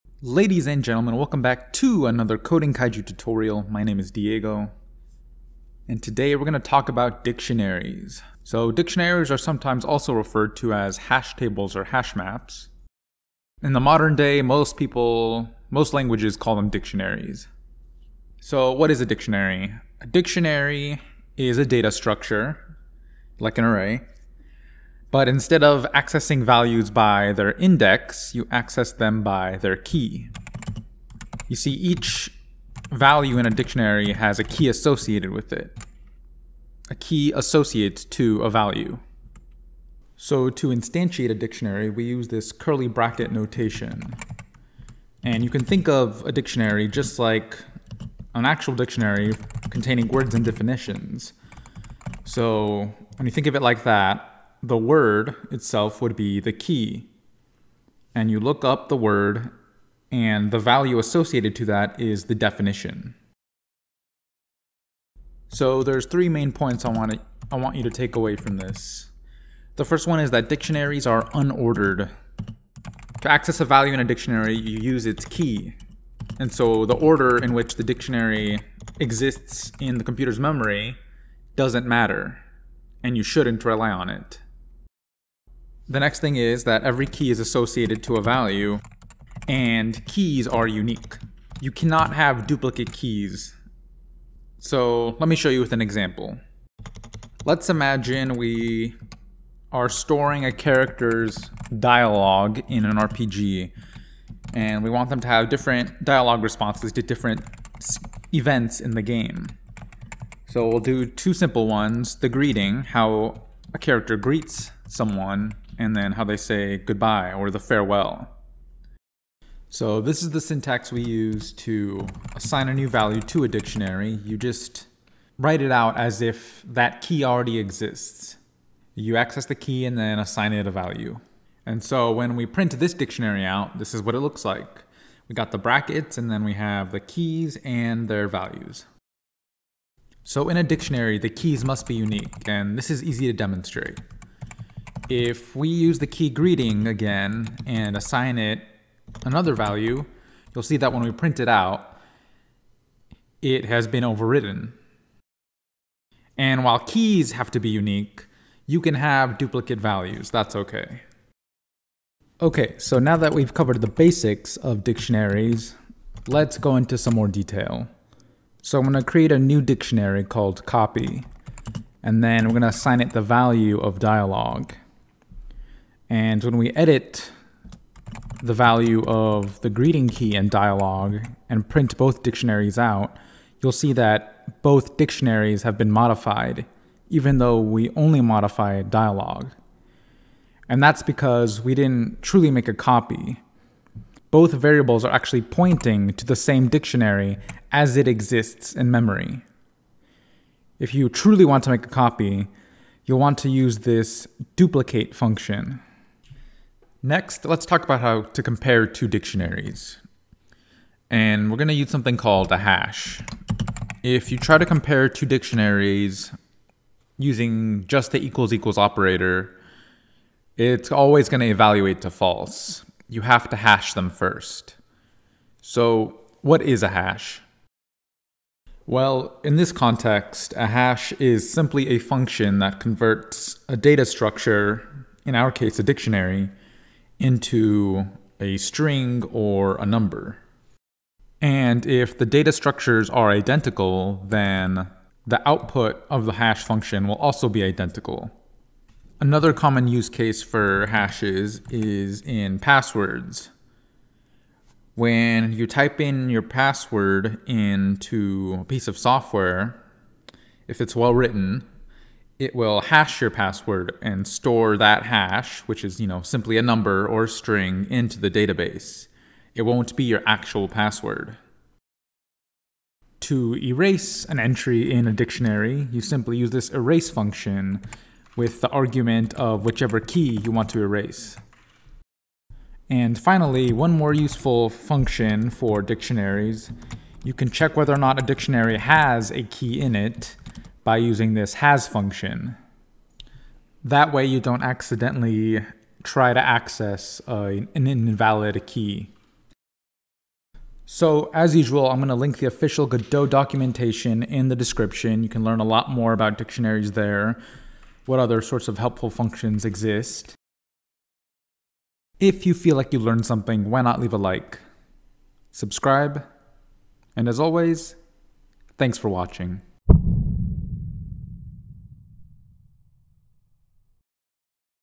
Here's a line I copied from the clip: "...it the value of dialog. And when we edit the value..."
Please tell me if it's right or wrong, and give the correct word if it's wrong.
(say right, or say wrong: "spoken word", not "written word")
right.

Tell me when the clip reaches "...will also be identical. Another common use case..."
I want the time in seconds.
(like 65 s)
247 s.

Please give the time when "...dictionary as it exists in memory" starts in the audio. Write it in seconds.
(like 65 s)
196 s.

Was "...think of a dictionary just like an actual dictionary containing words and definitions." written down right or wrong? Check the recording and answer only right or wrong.
right.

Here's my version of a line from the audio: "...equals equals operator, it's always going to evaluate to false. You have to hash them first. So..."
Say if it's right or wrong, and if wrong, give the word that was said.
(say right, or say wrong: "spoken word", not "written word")
right.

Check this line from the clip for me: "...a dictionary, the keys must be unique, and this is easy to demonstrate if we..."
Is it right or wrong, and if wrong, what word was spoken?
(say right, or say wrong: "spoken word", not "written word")
right.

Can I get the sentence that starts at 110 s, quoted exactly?
So we'll do two simple ones, the greeting, how a character greets someone, and then how they say goodbye or the farewell.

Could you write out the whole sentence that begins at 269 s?
It won't be your actual password.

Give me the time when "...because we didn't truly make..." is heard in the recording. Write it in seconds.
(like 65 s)
191 s.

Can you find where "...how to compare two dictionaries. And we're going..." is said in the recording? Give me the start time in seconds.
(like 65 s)
208 s.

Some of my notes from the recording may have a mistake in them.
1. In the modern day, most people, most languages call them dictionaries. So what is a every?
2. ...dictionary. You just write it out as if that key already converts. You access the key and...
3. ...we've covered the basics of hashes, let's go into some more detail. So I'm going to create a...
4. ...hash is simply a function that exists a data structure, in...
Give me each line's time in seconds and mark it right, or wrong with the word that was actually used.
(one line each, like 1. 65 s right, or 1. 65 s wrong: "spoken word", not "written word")
1. 13 s wrong: "dictionary", not "every"
2. 123 s wrong: "exists", not "converts"
3. 163 s wrong: "dictionaries", not "hashes"
4. 230 s wrong: "converts", not "exists".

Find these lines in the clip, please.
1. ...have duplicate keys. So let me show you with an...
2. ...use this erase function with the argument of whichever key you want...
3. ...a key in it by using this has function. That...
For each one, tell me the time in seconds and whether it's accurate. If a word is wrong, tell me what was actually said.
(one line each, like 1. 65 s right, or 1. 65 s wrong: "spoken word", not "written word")
1. 92 s right
2. 276 s right
3. 289 s right.